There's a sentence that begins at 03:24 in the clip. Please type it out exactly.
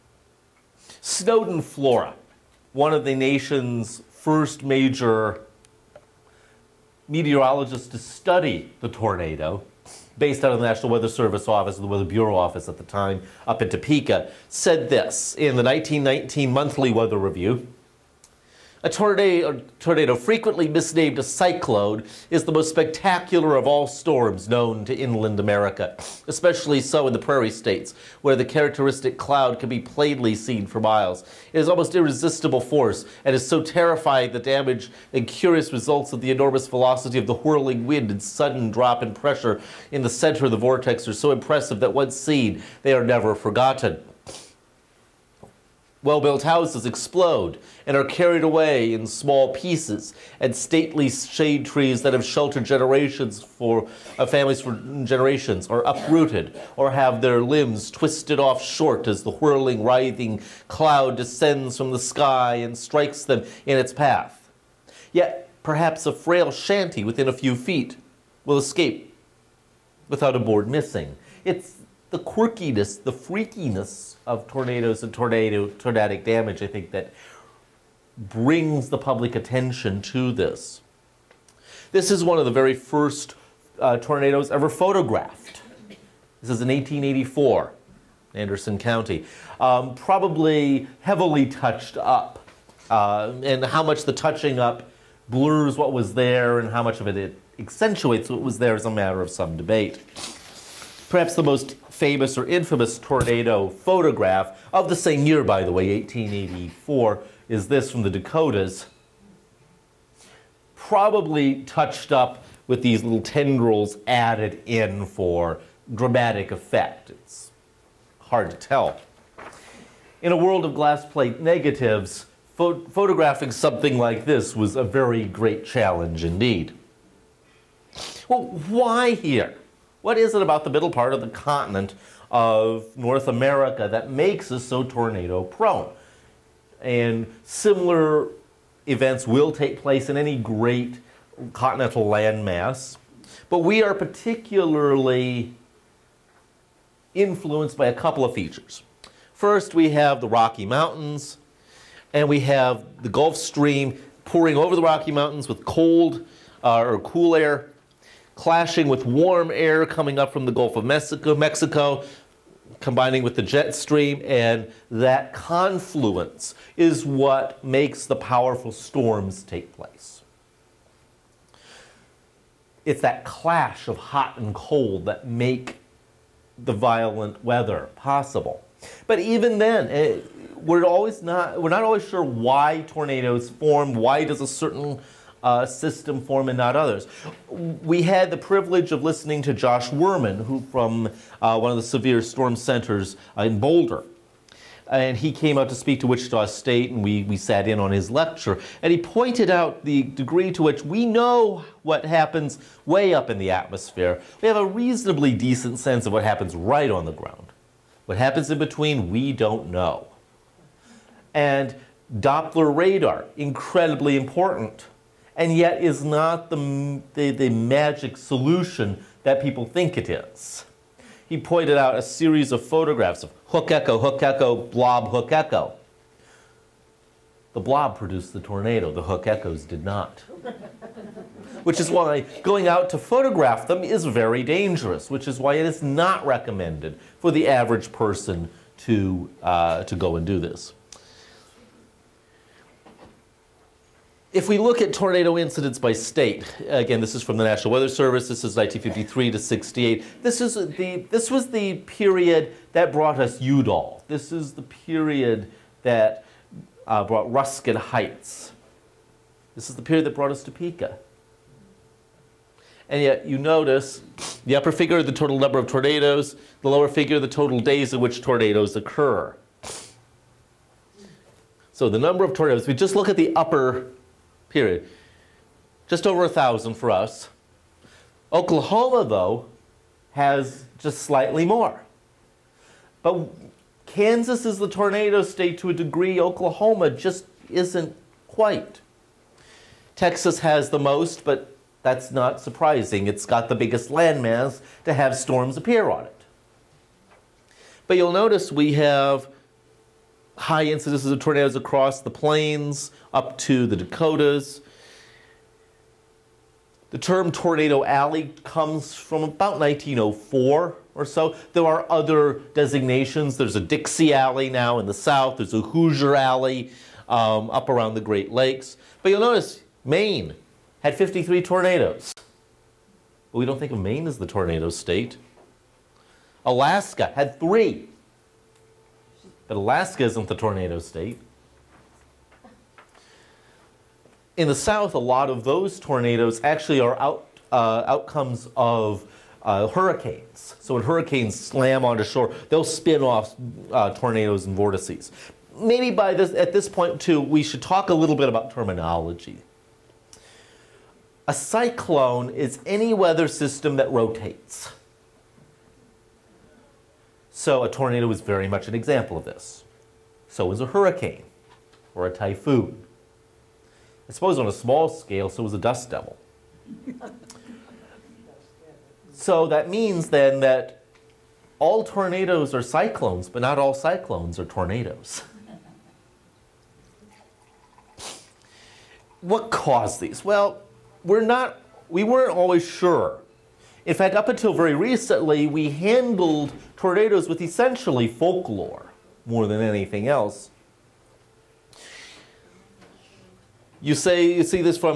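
We have a reasonably decent sense of what happens right on the ground.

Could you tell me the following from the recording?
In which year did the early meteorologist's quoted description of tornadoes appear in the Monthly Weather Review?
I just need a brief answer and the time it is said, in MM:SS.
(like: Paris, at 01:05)
1919, at 00:15.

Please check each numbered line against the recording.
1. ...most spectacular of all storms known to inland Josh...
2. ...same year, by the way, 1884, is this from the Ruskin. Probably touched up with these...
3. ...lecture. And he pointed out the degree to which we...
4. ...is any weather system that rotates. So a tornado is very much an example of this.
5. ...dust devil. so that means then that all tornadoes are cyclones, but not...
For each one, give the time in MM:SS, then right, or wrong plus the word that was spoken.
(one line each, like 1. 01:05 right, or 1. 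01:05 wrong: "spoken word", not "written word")
1. 00:22 wrong: "America", not "Josh"
2. 01:44 wrong: "Dakotas", not "Ruskin"
3. 03:18 right
4. 05:52 right
5. 06:05 right.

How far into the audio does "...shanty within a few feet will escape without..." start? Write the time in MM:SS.
01:06.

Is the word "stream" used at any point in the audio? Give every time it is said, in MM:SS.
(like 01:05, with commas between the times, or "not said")
02:33, 02:43.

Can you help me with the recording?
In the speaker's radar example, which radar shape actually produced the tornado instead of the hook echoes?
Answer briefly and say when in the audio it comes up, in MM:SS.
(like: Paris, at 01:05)
The blob, at 03:47.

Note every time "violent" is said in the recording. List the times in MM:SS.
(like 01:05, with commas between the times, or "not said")
02:56.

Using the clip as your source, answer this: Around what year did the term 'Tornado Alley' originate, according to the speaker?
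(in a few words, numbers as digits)
1904.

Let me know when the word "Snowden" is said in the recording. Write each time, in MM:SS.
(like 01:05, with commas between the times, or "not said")
00:01.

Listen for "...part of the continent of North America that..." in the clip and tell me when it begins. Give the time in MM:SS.
02:10.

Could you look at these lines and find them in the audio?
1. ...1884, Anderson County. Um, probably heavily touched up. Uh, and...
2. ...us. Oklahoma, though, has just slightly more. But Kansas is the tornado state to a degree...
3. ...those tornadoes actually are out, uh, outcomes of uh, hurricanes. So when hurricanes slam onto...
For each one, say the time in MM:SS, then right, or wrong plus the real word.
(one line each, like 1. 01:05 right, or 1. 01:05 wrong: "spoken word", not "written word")
1. 01:26 right
2. 04:36 right
3. 05:35 right.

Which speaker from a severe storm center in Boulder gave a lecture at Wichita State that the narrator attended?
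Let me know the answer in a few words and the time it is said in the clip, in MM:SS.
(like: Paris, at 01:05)
Josh Wurman, at 03:09.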